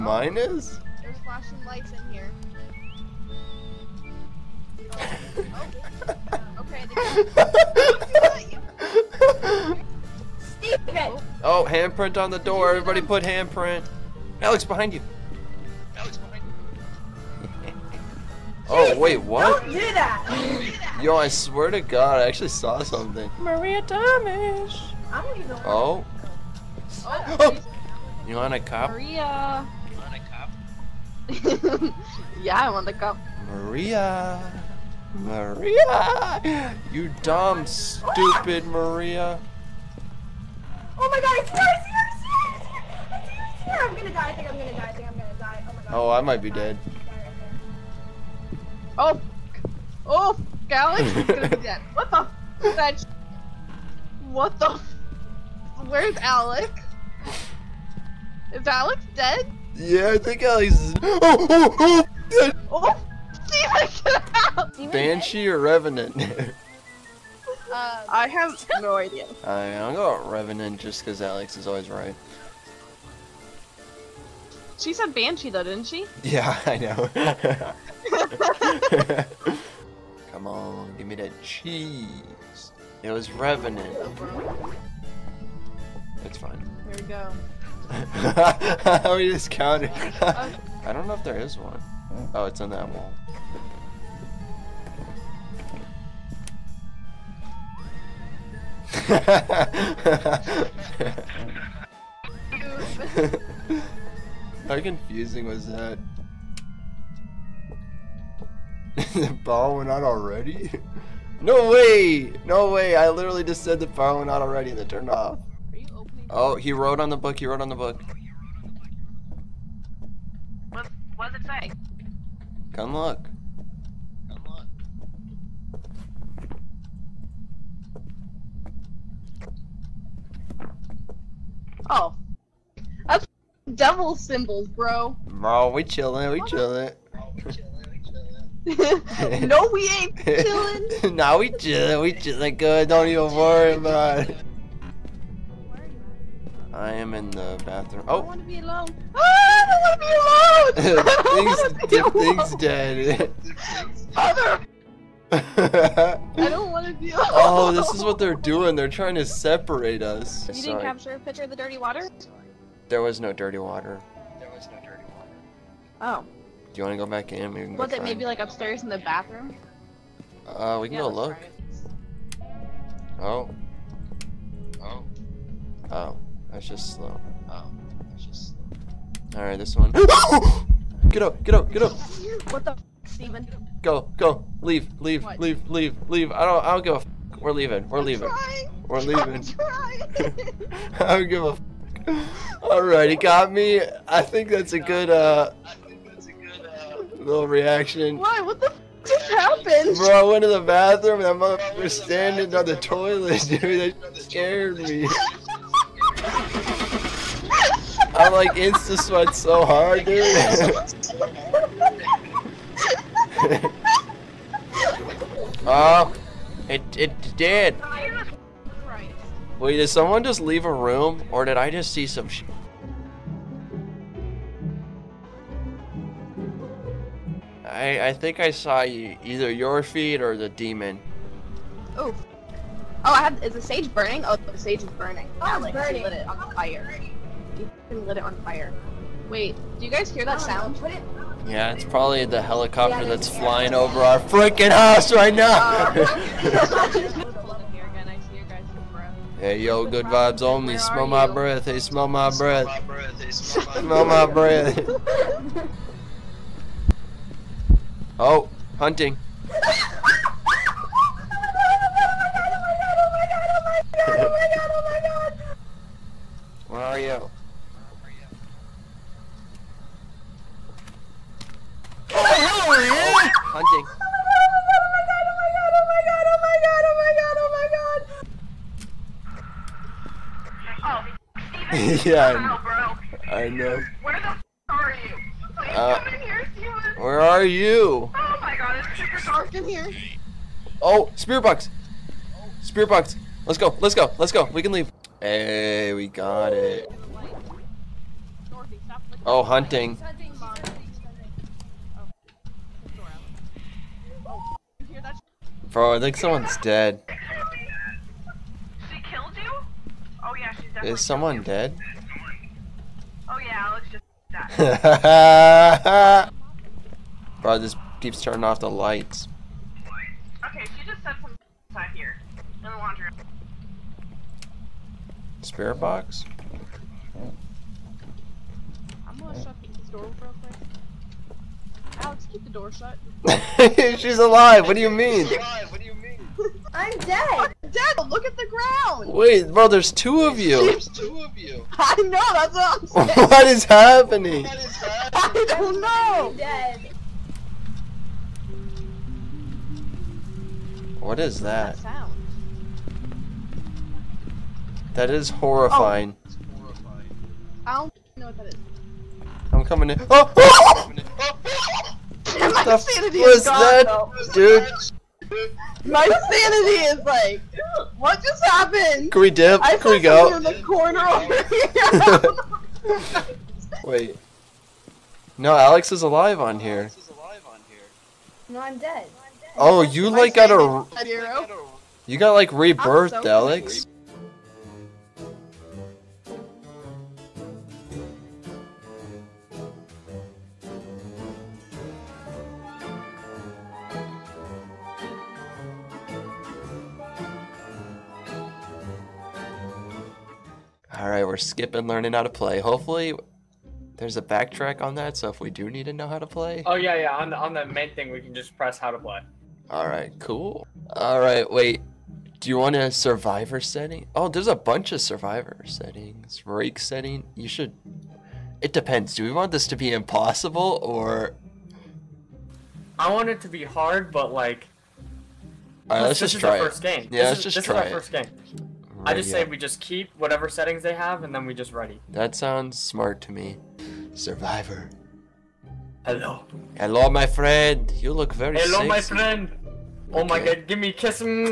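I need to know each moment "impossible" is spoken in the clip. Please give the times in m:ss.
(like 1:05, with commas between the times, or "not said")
6:59.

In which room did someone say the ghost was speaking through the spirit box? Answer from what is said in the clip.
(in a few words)
Laundry room.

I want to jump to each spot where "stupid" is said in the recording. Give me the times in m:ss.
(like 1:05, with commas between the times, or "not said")
0:37.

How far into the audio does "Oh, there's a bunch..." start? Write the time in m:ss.
6:54.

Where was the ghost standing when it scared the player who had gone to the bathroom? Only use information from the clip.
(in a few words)
On the toilet.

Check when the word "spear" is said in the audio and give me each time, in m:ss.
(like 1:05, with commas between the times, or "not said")
4:51.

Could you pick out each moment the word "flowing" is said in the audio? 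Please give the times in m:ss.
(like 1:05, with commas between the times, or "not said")
not said.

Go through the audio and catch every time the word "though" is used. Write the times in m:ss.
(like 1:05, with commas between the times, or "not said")
1:15, 6:03.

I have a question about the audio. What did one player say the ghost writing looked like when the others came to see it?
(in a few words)
Devil symbols.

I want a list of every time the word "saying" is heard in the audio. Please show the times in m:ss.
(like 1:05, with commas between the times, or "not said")
5:43.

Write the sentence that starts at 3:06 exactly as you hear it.
I don't, I don't give a f We're leaving, we're I'm leaving.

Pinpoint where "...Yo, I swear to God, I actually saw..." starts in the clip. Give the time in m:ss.
0:21.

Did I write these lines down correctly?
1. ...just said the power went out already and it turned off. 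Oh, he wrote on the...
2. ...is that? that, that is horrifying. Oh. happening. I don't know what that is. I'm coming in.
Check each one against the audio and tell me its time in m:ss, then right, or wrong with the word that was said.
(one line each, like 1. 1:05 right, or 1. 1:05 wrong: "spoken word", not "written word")
1. 1:53 right
2. 5:51 wrong: "horrifying", not "happening".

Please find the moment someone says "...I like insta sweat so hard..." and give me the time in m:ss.
3:28.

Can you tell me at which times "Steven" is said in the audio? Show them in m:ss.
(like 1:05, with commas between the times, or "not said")
1:03, 3:03.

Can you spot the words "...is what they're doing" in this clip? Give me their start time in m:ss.
2:37.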